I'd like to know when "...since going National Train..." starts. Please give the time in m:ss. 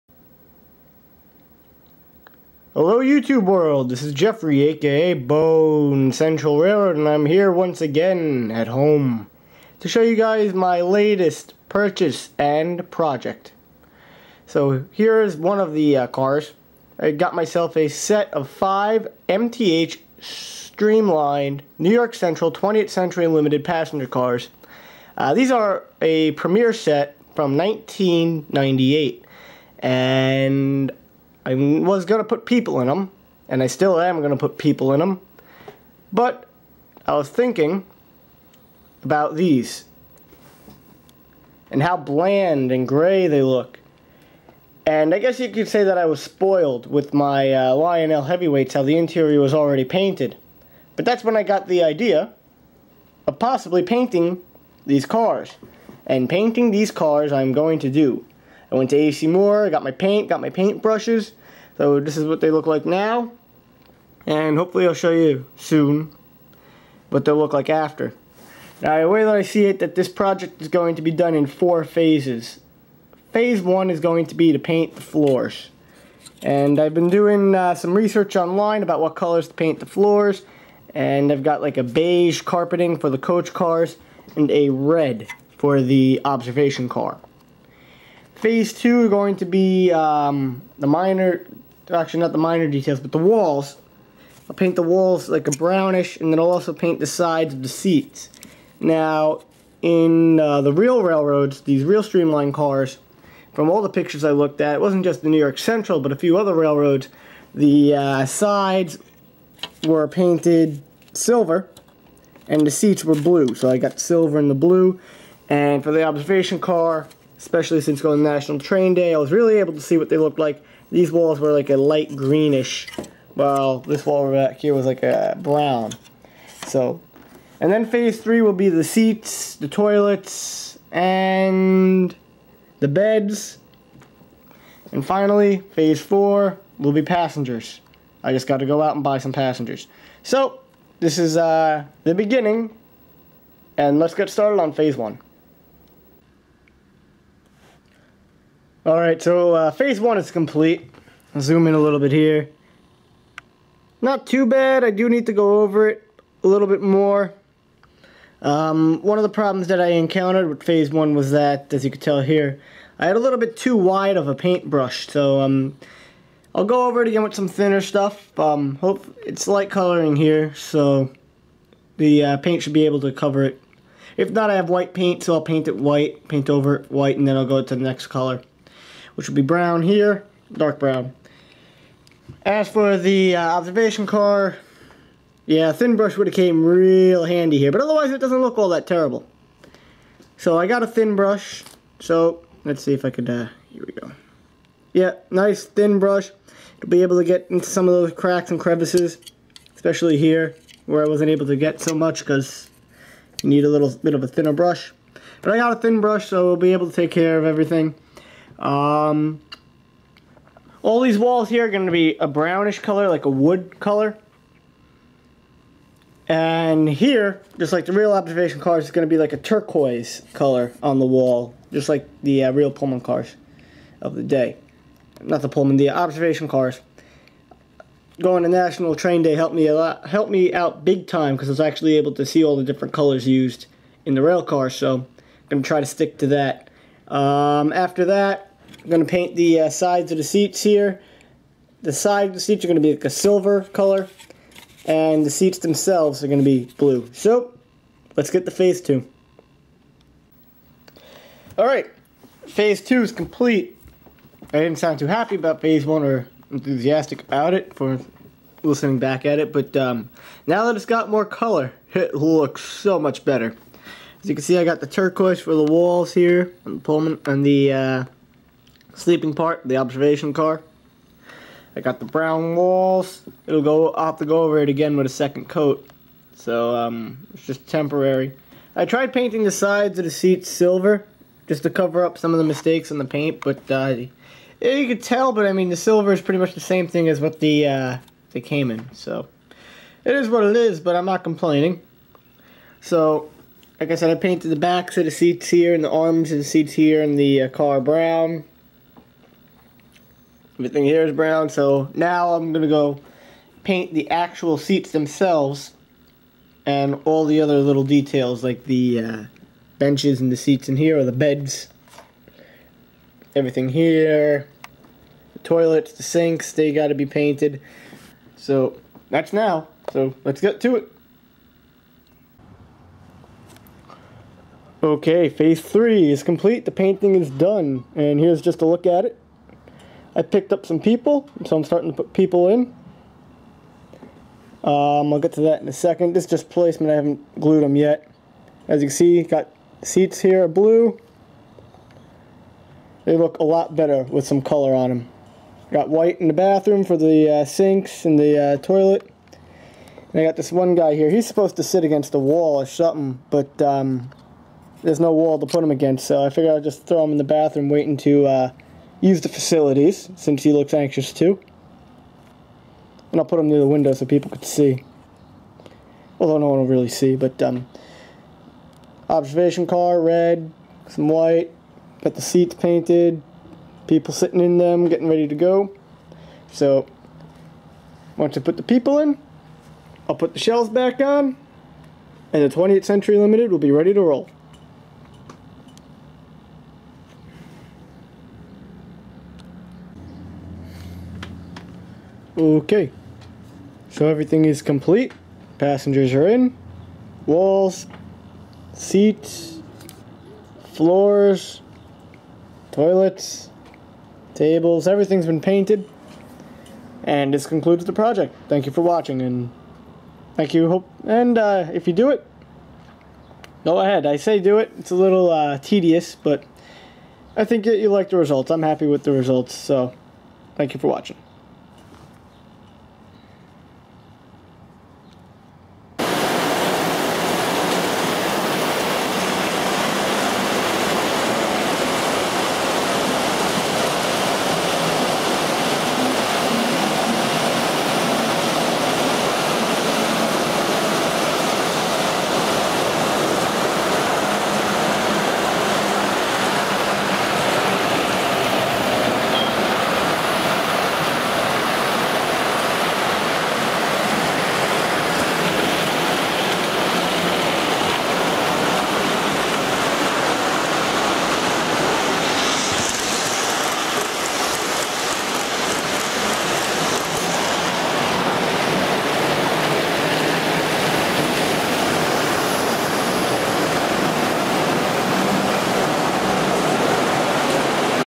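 1:57.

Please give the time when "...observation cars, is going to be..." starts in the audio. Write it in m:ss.
3:38.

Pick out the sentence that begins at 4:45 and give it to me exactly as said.
But I mean, the silver is pretty much the same thing as what the uh, they came in.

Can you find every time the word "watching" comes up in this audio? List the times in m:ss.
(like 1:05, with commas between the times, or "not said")
6:48, 7:00.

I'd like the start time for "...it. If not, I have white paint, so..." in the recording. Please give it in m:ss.
2:53.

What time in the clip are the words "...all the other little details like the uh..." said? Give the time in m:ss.
5:07.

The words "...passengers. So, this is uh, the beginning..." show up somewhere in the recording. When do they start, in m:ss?
2:19.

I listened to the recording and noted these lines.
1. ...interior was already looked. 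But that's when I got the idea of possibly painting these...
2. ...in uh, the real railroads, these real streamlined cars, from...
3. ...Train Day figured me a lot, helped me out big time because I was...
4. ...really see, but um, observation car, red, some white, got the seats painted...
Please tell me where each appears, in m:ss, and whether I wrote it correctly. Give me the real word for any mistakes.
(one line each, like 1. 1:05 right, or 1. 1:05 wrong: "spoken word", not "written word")
1. 0:48 wrong: "painted", not "looked"
2. 1:39 right
3. 3:48 wrong: "helped", not "figured"
4. 6:06 right.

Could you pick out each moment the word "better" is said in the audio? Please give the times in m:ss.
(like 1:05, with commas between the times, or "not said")
4:23, 5:43.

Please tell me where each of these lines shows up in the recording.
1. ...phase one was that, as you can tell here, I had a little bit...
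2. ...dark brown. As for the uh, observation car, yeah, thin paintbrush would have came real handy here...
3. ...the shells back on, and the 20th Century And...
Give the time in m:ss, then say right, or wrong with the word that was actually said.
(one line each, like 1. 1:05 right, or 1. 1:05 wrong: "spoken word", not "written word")
1. 2:40 right
2. 3:00 wrong: "brush", not "paintbrush"
3. 6:20 wrong: "Limited", not "And".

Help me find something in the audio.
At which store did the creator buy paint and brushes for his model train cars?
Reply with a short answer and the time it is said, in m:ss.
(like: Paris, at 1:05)
AC Moore, at 0:58.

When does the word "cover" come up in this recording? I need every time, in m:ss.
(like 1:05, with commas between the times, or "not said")
2:53, 4:41.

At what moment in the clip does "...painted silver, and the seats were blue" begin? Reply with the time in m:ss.
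1:50.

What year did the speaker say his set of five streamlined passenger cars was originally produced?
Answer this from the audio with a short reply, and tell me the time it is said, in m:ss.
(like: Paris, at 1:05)
1998, at 0:27.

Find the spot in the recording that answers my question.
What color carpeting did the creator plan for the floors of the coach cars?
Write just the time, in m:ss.
1:21.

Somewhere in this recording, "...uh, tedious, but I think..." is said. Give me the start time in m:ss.
6:55.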